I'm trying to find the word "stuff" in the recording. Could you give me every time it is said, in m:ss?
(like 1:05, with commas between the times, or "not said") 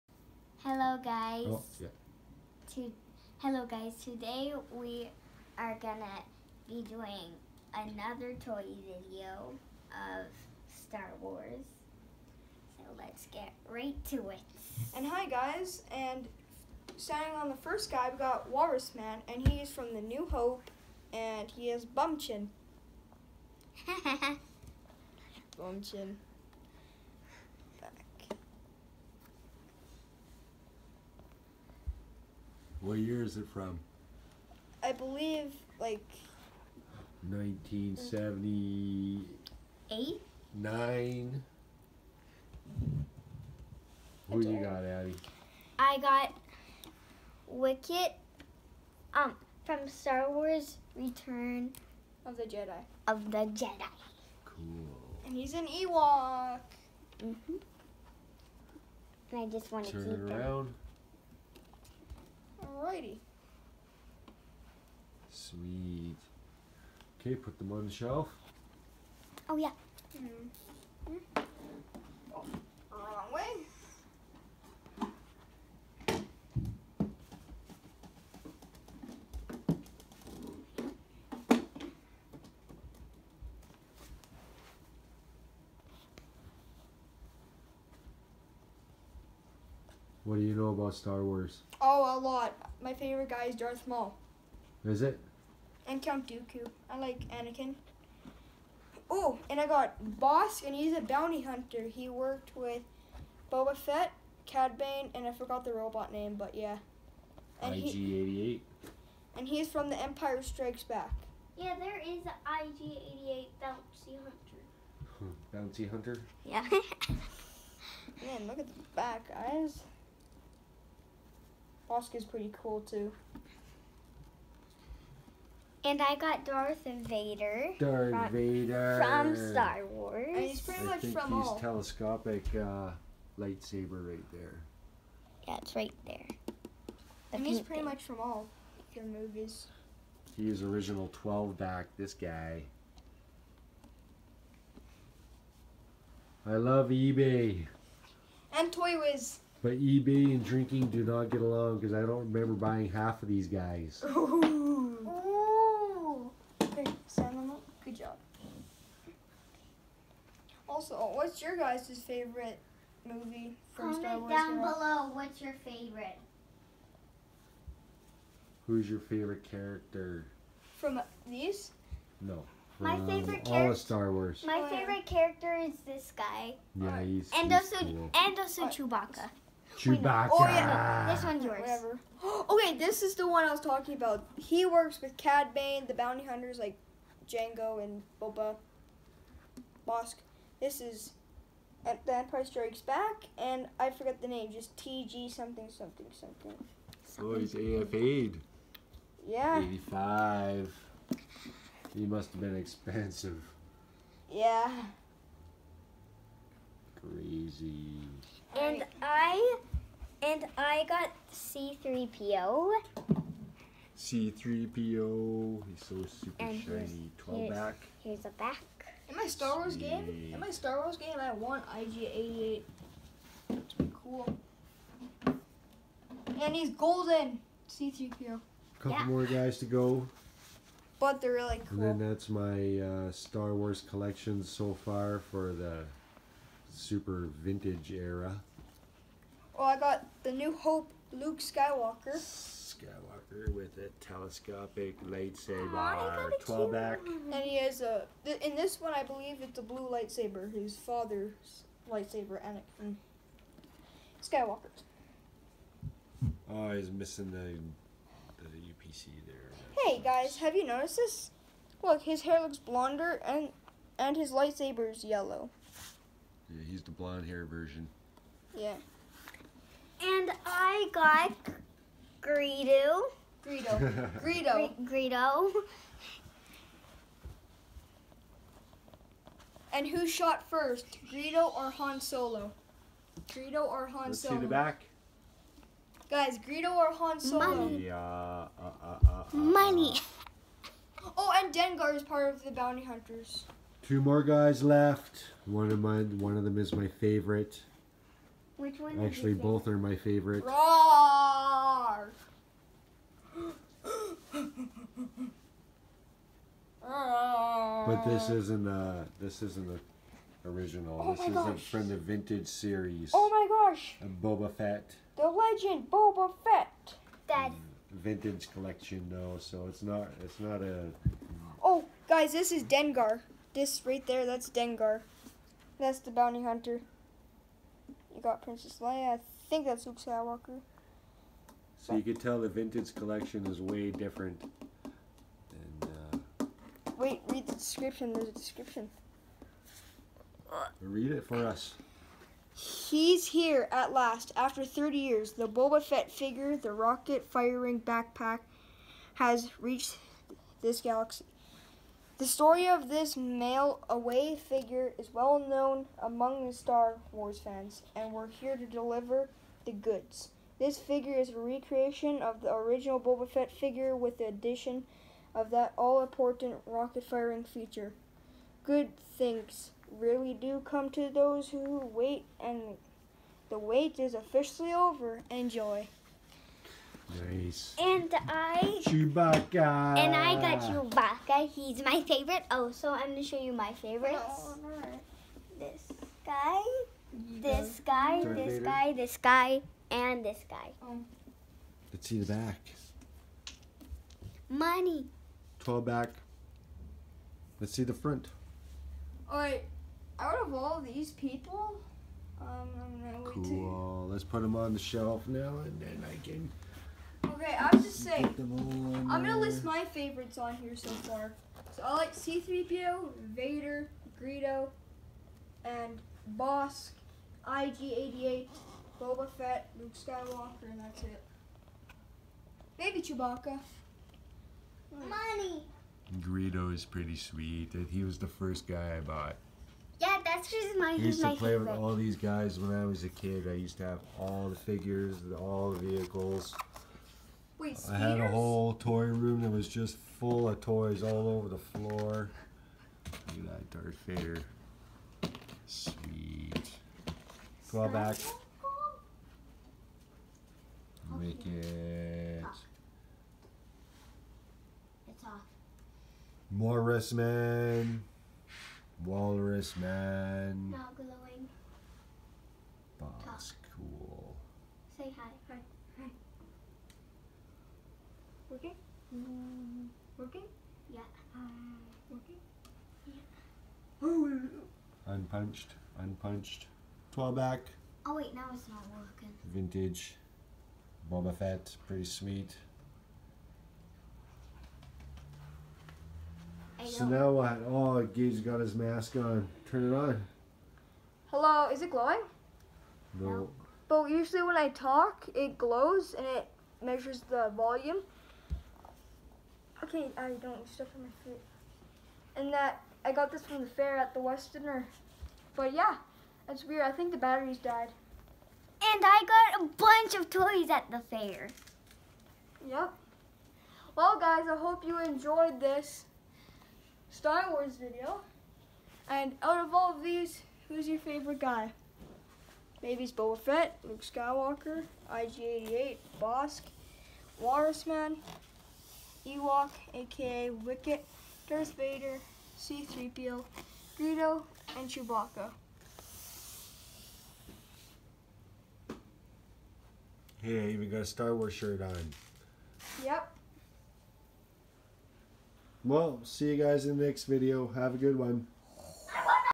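8:20.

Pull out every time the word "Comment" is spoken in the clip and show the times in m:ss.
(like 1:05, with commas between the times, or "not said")
2:43.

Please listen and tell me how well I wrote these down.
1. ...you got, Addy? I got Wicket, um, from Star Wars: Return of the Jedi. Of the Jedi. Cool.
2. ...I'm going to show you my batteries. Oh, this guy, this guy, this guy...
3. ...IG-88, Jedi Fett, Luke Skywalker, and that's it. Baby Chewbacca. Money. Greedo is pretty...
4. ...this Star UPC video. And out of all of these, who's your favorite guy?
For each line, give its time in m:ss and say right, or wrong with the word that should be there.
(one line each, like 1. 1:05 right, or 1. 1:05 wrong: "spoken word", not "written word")
1. 0:44 right
2. 6:22 wrong: "favorites", not "batteries"
3. 6:57 wrong: "Boba", not "Jedi"
4. 8:35 wrong: "Wars", not "UPC".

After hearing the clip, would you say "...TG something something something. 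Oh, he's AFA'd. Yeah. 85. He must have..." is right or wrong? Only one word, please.
right.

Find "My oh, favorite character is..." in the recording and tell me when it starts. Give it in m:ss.
2:54.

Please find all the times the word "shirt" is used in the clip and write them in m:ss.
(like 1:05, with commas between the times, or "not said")
9:01.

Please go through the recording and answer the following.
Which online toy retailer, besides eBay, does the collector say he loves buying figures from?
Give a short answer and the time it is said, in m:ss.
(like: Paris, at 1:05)
Toy Wiz, at 2:28.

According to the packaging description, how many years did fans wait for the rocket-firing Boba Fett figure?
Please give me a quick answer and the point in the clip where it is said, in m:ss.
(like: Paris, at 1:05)
30 years, at 5:44.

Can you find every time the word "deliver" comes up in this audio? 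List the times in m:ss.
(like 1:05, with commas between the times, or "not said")
5:58.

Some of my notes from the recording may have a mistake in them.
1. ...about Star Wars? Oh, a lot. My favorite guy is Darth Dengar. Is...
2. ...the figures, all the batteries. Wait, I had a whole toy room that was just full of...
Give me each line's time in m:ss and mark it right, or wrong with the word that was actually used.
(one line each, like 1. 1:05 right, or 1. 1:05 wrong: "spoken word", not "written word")
1. 1:30 wrong: "Maul", not "Dengar"
2. 7:14 wrong: "vehicles", not "batteries".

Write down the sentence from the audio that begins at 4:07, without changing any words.
And he has a, th in this one I believe it's a blue lightsaber, his father's lightsaber, Anakin Skywalker.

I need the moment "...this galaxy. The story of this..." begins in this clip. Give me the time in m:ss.
5:50.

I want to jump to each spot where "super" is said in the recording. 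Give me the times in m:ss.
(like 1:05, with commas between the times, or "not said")
3:36, 3:56.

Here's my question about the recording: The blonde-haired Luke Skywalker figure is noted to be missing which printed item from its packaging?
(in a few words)
the UPC.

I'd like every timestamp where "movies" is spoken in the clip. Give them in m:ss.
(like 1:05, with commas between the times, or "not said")
2:19, 2:43.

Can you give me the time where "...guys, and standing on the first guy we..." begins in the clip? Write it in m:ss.
0:15.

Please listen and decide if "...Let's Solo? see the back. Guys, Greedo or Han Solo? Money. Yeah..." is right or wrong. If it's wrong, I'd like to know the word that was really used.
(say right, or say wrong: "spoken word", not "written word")
right.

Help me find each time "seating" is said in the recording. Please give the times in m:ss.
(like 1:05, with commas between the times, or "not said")
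not said.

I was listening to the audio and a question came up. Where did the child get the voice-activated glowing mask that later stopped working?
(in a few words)
the fair at the Westerner.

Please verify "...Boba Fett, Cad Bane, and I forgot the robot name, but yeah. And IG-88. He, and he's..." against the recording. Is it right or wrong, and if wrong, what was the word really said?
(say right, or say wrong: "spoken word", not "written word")
right.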